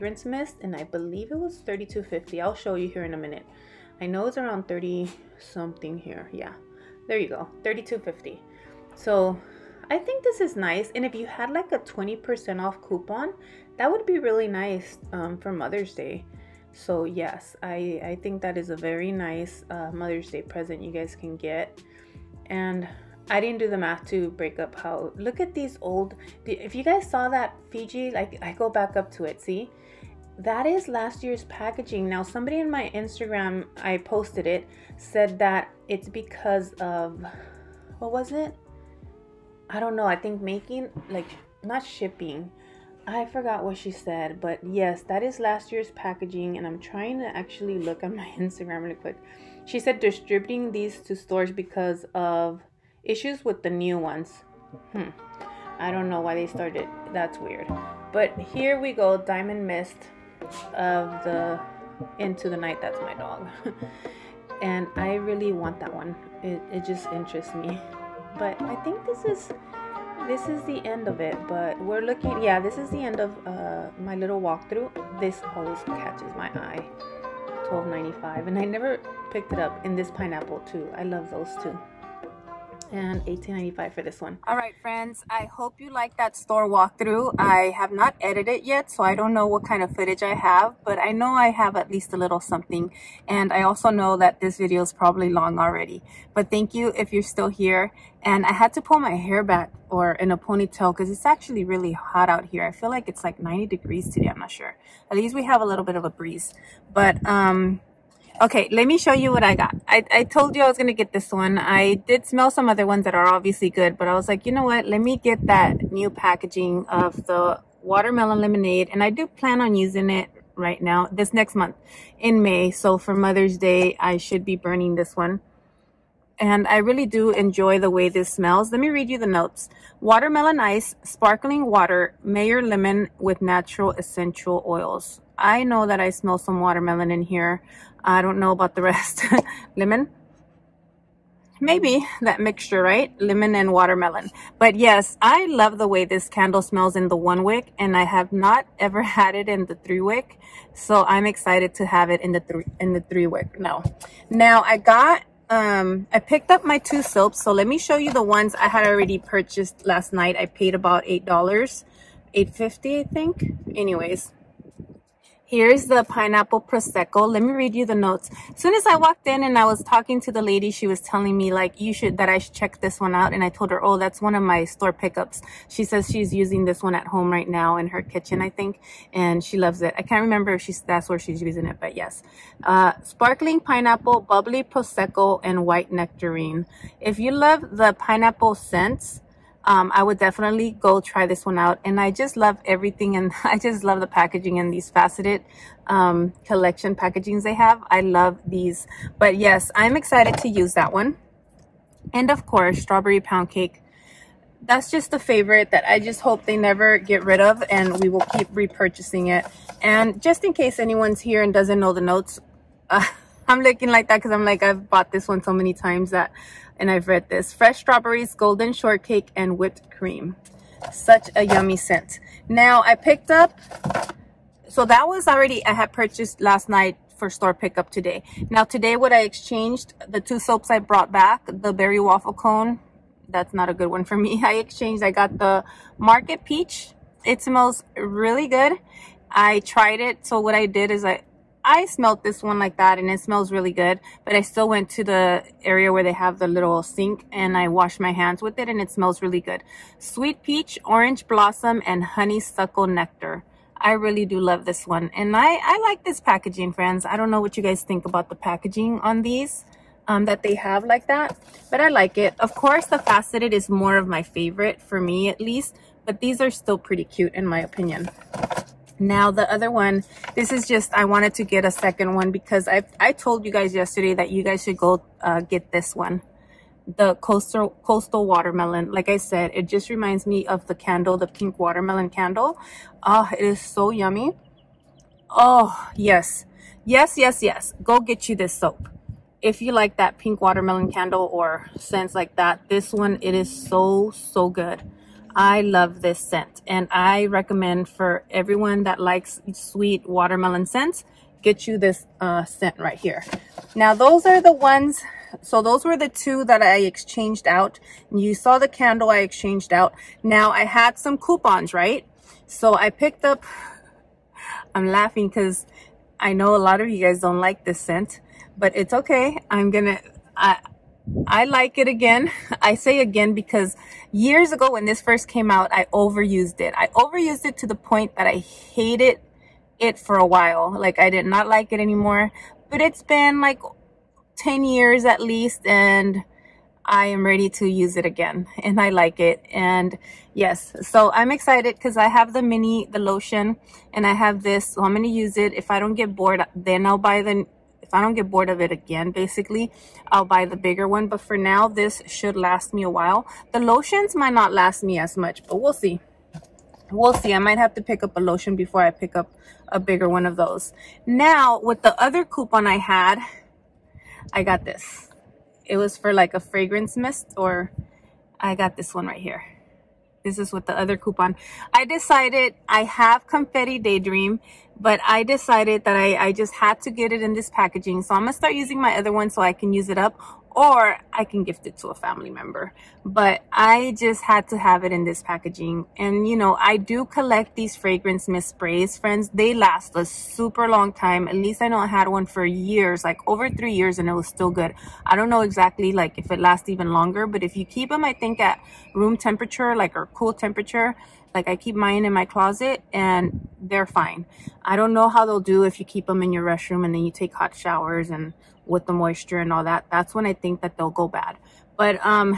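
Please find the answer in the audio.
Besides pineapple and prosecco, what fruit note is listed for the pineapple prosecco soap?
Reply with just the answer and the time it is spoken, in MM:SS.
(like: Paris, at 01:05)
white nectarine, at 03:05.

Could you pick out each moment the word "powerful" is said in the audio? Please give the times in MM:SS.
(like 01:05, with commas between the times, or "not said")
not said.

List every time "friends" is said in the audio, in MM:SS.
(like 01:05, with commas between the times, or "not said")
01:24, 04:16, 06:28.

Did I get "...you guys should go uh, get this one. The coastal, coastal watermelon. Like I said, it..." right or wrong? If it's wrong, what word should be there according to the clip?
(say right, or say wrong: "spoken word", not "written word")
right.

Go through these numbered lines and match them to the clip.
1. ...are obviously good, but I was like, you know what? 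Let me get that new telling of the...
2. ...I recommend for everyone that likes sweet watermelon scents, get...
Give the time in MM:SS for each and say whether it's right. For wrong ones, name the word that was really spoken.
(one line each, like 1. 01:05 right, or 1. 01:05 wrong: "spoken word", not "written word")
1. 01:53 wrong: "packaging", not "telling"
2. 04:56 right.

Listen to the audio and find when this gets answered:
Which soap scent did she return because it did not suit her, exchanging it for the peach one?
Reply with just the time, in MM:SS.
03:51.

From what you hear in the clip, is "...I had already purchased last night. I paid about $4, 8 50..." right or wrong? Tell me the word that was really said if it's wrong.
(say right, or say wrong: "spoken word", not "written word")
wrong: "8", not "4".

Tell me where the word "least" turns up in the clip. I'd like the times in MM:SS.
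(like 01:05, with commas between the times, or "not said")
01:31, 01:45, 04:25, 05:35, 06:31.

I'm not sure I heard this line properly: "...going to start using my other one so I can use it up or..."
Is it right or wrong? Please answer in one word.
right.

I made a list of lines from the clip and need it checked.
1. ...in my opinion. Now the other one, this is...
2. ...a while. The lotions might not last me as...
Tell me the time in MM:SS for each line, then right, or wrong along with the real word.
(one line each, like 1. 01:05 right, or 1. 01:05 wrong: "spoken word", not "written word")
1. 04:27 right
2. 05:52 right.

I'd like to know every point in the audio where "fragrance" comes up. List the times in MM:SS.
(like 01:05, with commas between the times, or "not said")
06:06, 06:27.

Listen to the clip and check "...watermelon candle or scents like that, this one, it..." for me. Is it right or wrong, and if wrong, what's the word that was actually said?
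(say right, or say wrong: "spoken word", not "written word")
right.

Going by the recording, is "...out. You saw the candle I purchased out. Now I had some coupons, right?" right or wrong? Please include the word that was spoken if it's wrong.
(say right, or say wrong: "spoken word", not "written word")
wrong: "exchanged", not "purchased".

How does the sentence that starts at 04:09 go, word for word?
Sweet peach, orange blossom, and honeysuckle nectar.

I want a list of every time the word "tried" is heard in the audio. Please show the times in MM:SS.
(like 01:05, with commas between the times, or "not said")
03:59.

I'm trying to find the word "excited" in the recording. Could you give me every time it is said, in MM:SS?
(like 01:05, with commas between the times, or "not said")
02:31, 03:19, 05:41.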